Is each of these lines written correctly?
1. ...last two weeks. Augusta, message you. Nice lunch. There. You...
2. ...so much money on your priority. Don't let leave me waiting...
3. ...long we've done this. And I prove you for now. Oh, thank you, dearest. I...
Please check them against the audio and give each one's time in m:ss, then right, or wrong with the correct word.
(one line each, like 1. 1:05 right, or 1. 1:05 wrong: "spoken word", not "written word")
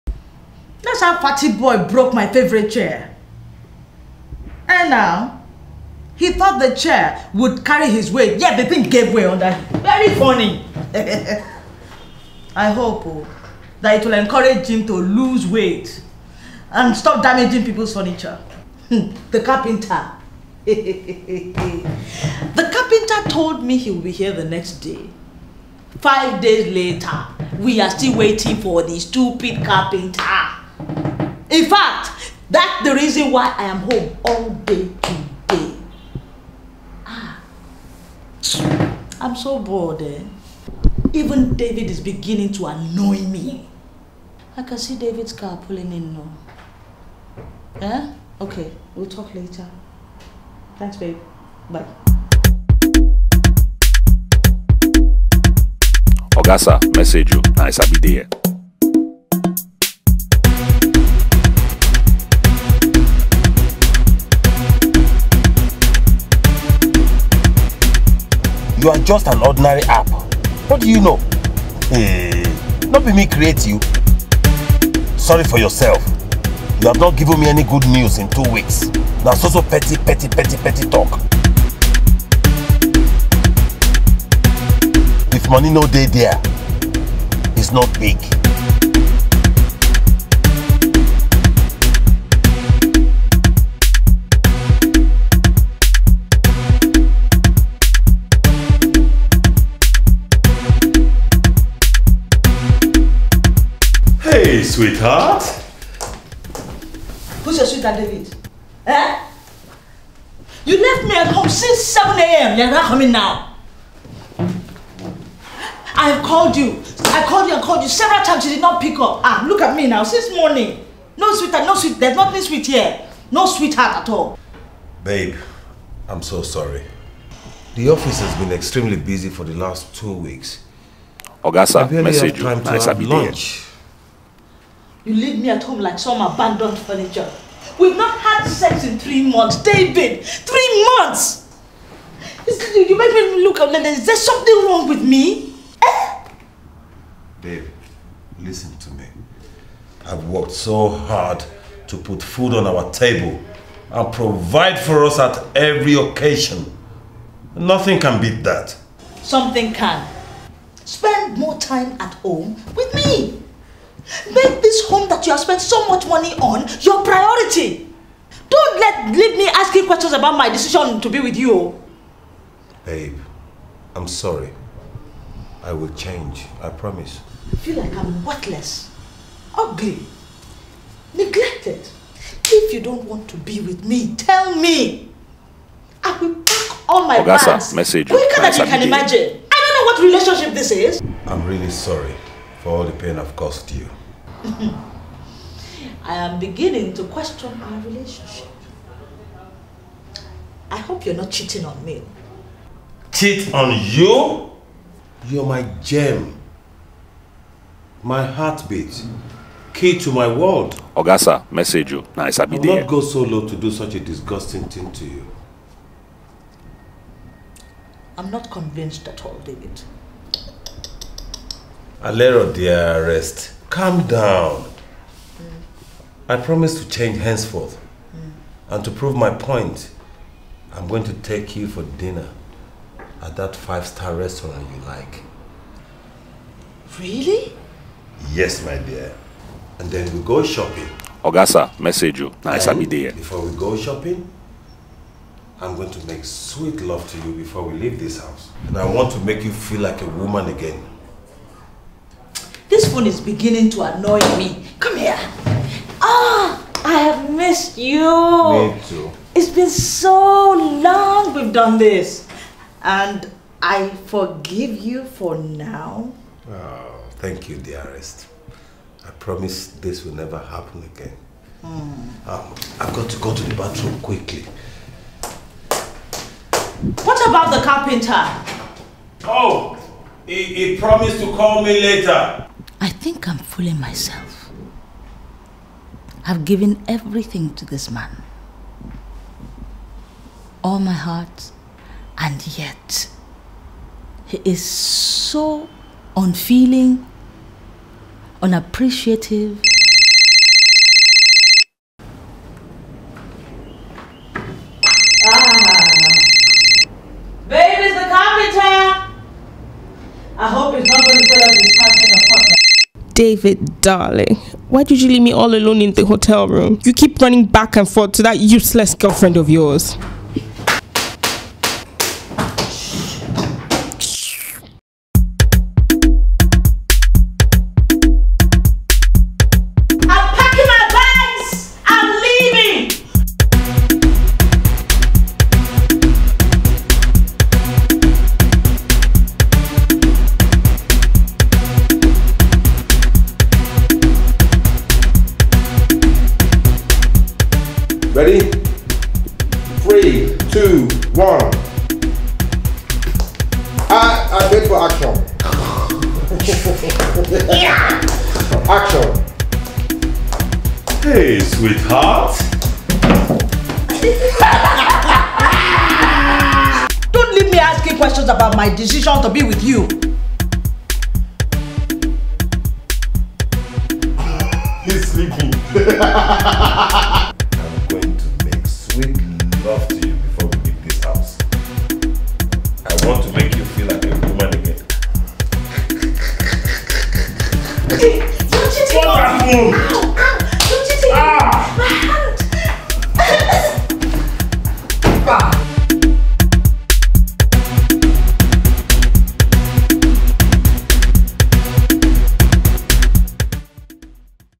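1. 2:09 right
2. 2:45 wrong: "asking", not "waiting"
3. 4:20 wrong: "forgive", not "prove".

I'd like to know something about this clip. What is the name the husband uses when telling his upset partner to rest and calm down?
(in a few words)
Alero.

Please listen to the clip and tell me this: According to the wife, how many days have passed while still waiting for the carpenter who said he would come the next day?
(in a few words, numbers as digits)
5.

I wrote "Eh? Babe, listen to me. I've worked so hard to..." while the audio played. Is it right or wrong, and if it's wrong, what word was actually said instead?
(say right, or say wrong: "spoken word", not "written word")
right.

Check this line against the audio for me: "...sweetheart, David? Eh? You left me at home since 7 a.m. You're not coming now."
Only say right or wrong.
right.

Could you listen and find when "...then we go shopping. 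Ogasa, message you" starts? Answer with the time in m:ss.
3:59.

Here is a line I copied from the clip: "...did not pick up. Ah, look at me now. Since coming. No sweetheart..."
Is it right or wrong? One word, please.
wrong.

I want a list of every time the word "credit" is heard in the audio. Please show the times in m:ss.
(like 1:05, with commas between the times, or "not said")
not said.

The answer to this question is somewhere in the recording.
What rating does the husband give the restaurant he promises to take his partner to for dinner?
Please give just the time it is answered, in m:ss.
3:53.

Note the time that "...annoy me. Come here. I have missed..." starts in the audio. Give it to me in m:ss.
4:13.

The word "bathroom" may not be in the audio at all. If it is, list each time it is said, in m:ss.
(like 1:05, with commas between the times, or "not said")
4:33.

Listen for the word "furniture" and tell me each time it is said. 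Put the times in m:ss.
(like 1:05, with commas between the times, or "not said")
0:17, 2:16.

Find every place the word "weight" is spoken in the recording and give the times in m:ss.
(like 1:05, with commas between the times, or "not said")
0:08, 0:15.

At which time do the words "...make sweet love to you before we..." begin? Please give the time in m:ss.
4:06.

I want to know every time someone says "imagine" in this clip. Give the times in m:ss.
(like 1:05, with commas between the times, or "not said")
3:08.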